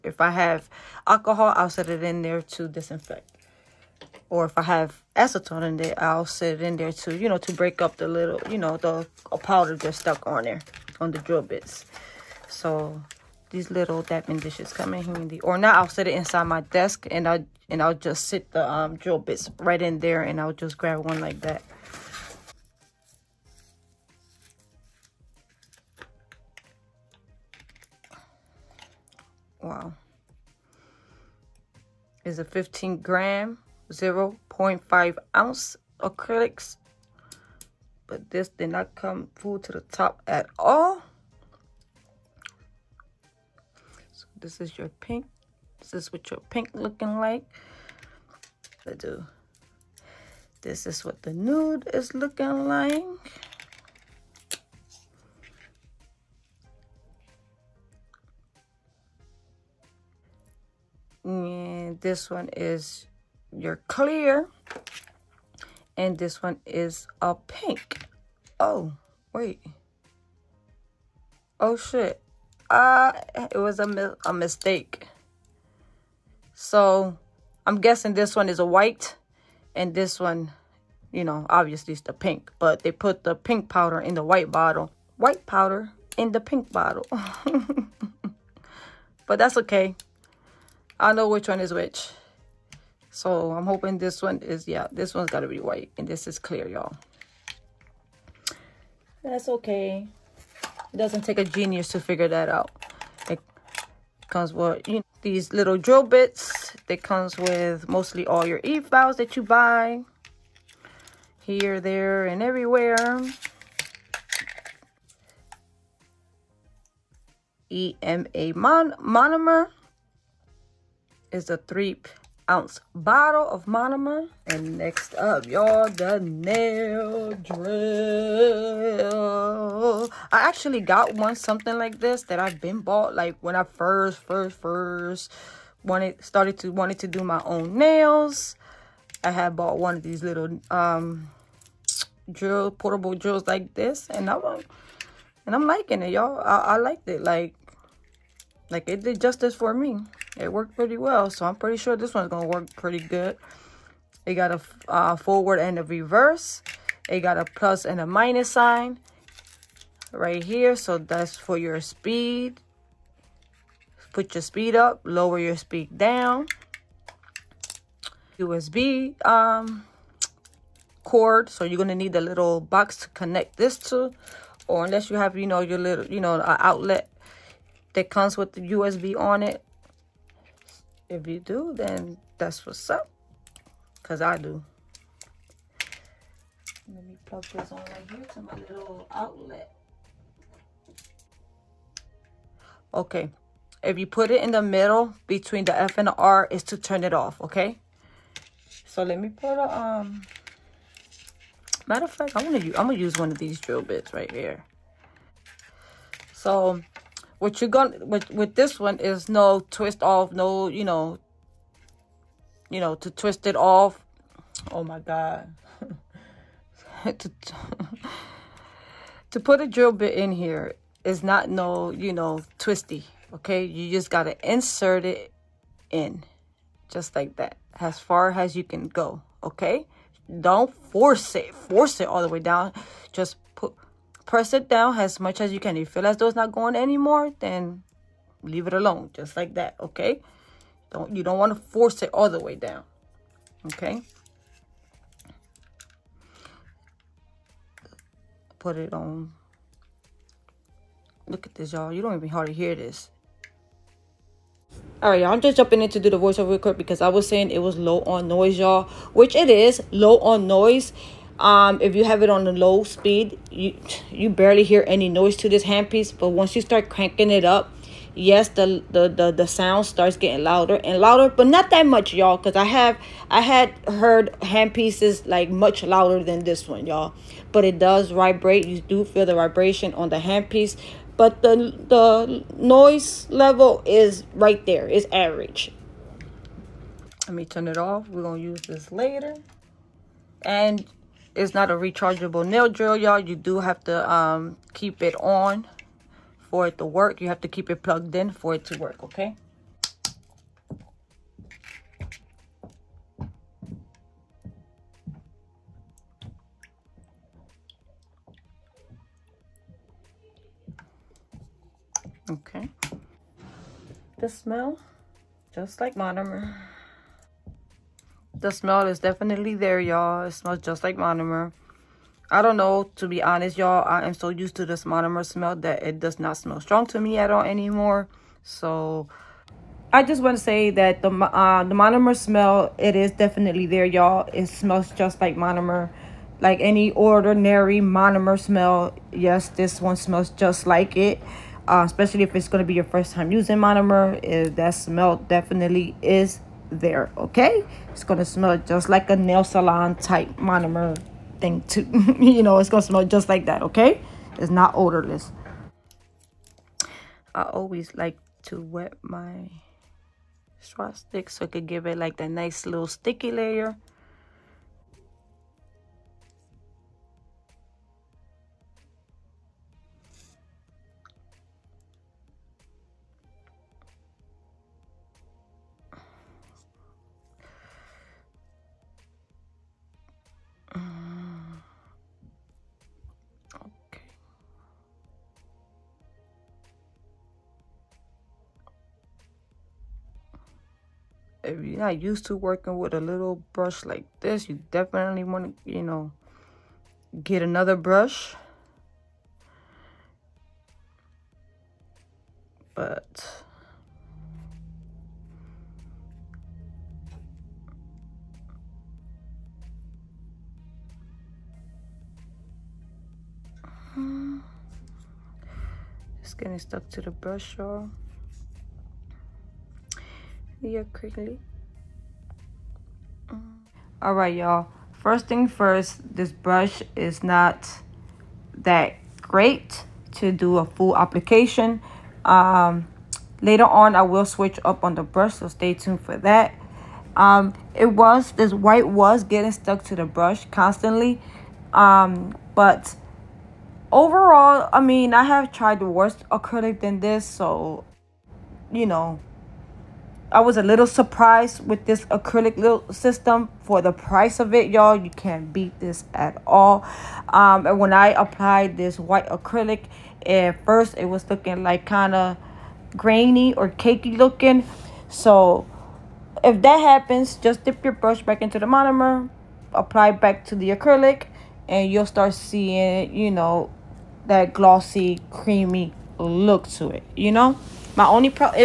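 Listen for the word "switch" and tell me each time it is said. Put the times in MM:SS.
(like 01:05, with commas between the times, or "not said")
07:14.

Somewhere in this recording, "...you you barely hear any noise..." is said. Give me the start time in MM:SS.
04:23.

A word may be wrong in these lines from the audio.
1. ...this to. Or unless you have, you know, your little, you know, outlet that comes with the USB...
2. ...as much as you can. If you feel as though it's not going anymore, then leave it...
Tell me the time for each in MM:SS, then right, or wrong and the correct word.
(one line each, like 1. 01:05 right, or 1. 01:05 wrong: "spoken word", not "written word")
1. 02:53 right
2. 03:54 right.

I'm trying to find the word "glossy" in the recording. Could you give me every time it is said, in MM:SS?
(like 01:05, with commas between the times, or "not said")
07:54.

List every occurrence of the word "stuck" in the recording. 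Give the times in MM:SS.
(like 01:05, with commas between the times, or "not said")
00:09, 06:56, 07:19.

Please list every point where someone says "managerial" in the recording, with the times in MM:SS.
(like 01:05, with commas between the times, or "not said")
not said.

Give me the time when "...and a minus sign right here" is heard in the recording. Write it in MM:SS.
02:37.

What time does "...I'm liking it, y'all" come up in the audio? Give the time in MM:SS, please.
02:25.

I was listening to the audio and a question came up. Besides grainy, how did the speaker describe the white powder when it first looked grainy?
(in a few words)
cakey looking.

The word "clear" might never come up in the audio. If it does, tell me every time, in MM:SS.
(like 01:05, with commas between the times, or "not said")
01:03, 01:36.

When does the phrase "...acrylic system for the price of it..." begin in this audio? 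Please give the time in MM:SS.
07:32.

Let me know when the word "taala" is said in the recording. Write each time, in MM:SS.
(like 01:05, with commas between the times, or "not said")
not said.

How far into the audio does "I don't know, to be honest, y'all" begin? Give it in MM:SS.
05:22.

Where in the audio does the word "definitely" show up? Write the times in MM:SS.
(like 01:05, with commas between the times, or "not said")
05:18, 05:33, 05:45, 06:34.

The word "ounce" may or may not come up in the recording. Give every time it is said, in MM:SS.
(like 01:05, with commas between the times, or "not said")
00:35, 02:02.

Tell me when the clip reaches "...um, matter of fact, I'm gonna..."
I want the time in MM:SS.
03:19.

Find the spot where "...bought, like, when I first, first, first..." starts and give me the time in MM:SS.
02:12.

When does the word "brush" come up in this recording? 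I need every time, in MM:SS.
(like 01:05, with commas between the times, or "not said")
06:33, 06:37, 06:57, 07:06, 07:15, 07:20, 07:47.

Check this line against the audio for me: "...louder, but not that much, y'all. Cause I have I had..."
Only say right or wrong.
right.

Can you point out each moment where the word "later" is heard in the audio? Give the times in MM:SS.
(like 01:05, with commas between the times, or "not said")
04:48, 07:13.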